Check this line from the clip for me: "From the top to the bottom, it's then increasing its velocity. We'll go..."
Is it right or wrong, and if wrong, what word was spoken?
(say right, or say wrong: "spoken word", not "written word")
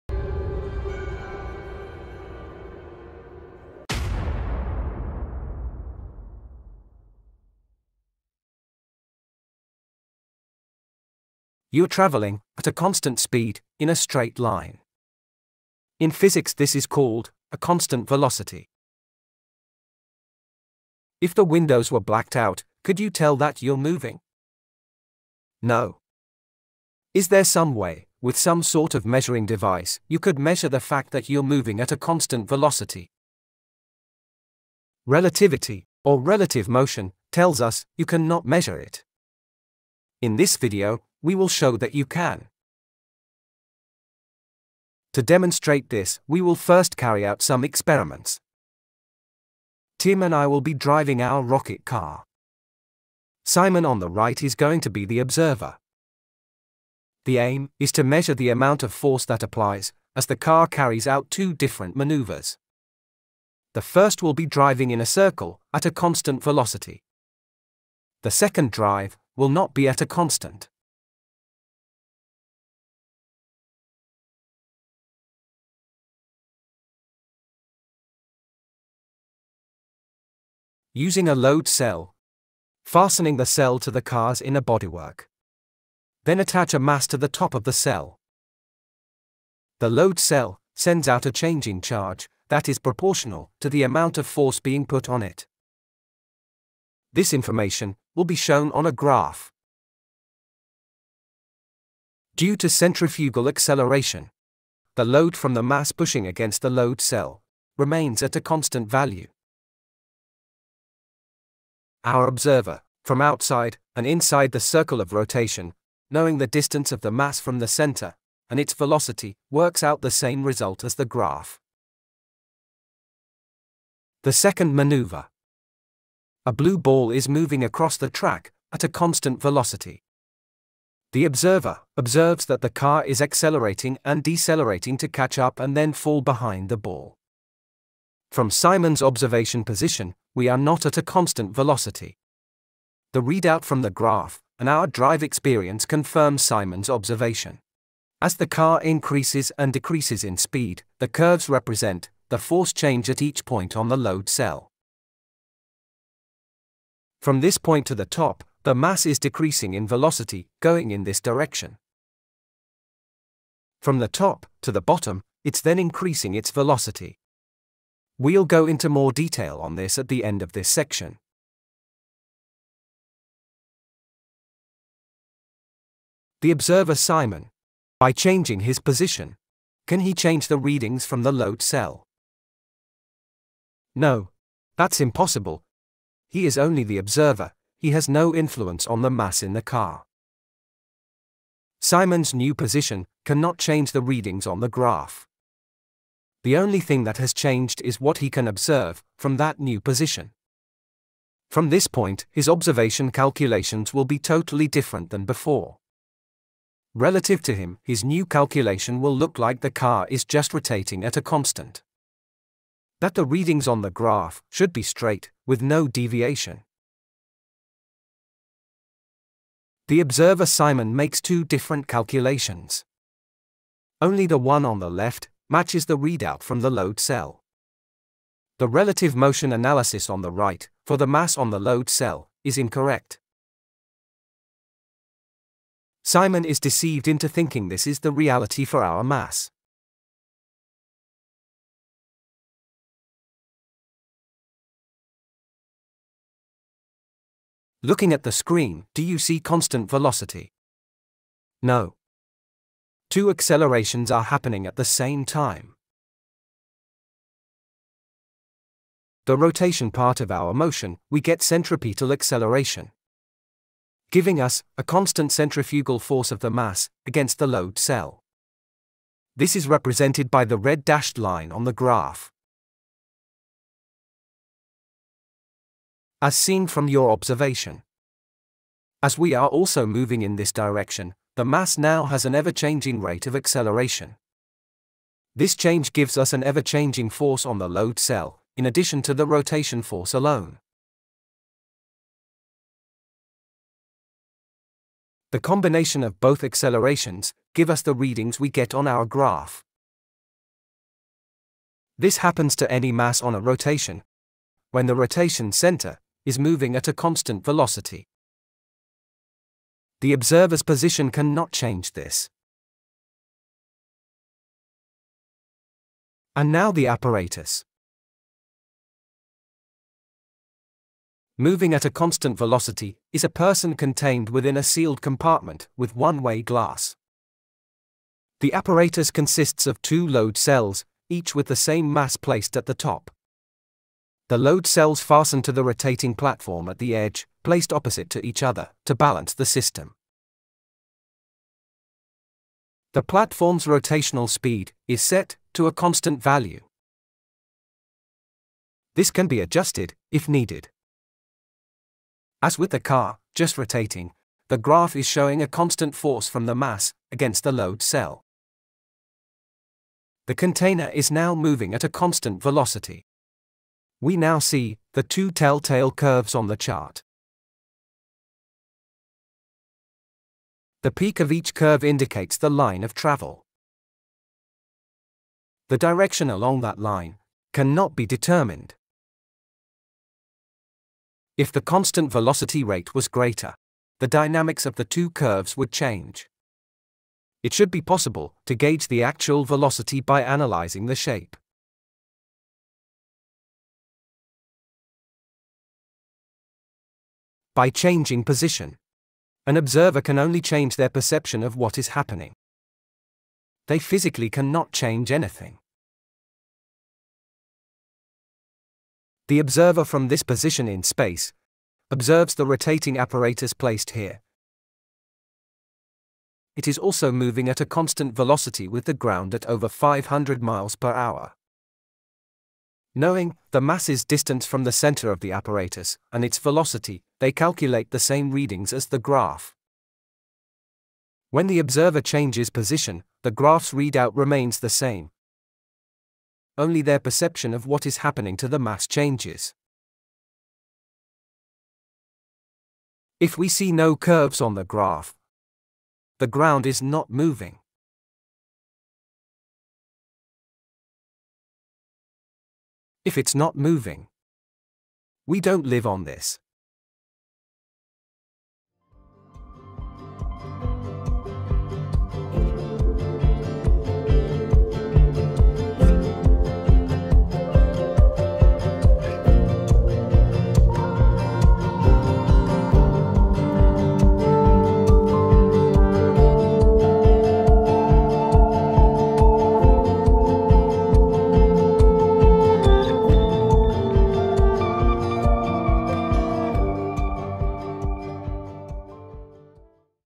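right.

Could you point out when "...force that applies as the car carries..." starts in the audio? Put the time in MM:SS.
00:58.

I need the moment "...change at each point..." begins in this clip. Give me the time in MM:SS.
02:32.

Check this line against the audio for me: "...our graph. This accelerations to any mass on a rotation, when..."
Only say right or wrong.
wrong.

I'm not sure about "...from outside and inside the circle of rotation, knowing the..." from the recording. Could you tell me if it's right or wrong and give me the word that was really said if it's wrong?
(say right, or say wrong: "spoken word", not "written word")
right.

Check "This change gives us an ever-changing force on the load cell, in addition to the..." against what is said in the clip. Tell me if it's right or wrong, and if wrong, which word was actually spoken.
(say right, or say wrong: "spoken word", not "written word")
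right.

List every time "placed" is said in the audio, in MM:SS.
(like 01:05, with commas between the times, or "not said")
05:32, 05:37, 06:53.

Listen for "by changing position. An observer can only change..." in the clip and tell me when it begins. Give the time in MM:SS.
06:37.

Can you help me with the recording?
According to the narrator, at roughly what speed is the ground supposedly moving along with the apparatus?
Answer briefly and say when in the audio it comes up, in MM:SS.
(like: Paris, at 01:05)
over 500 miles per hour, at 06:59.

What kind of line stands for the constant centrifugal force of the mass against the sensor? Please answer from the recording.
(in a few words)
red dashed line.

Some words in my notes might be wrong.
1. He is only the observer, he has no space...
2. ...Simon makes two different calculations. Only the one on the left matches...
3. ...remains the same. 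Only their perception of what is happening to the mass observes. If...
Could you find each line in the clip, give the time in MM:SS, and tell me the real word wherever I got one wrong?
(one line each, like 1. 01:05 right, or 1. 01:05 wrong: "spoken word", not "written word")
1. 03:06 wrong: "influence", not "space"
2. 03:40 right
3. 07:14 wrong: "changes", not "observes".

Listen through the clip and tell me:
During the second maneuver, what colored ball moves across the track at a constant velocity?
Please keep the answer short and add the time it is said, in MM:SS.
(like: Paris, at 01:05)
blue, at 02:06.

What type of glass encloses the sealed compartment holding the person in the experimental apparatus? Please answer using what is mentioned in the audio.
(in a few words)
one-way glass.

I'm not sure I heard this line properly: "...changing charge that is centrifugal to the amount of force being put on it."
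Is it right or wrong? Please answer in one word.
wrong.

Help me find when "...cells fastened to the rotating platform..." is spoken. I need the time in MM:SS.
05:34.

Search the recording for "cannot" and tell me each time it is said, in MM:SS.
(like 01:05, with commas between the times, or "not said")
00:38, 03:13, 05:11, 06:17, 06:44.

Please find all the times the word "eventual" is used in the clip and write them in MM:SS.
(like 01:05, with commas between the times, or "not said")
not said.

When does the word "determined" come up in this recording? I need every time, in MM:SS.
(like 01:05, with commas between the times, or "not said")
06:18.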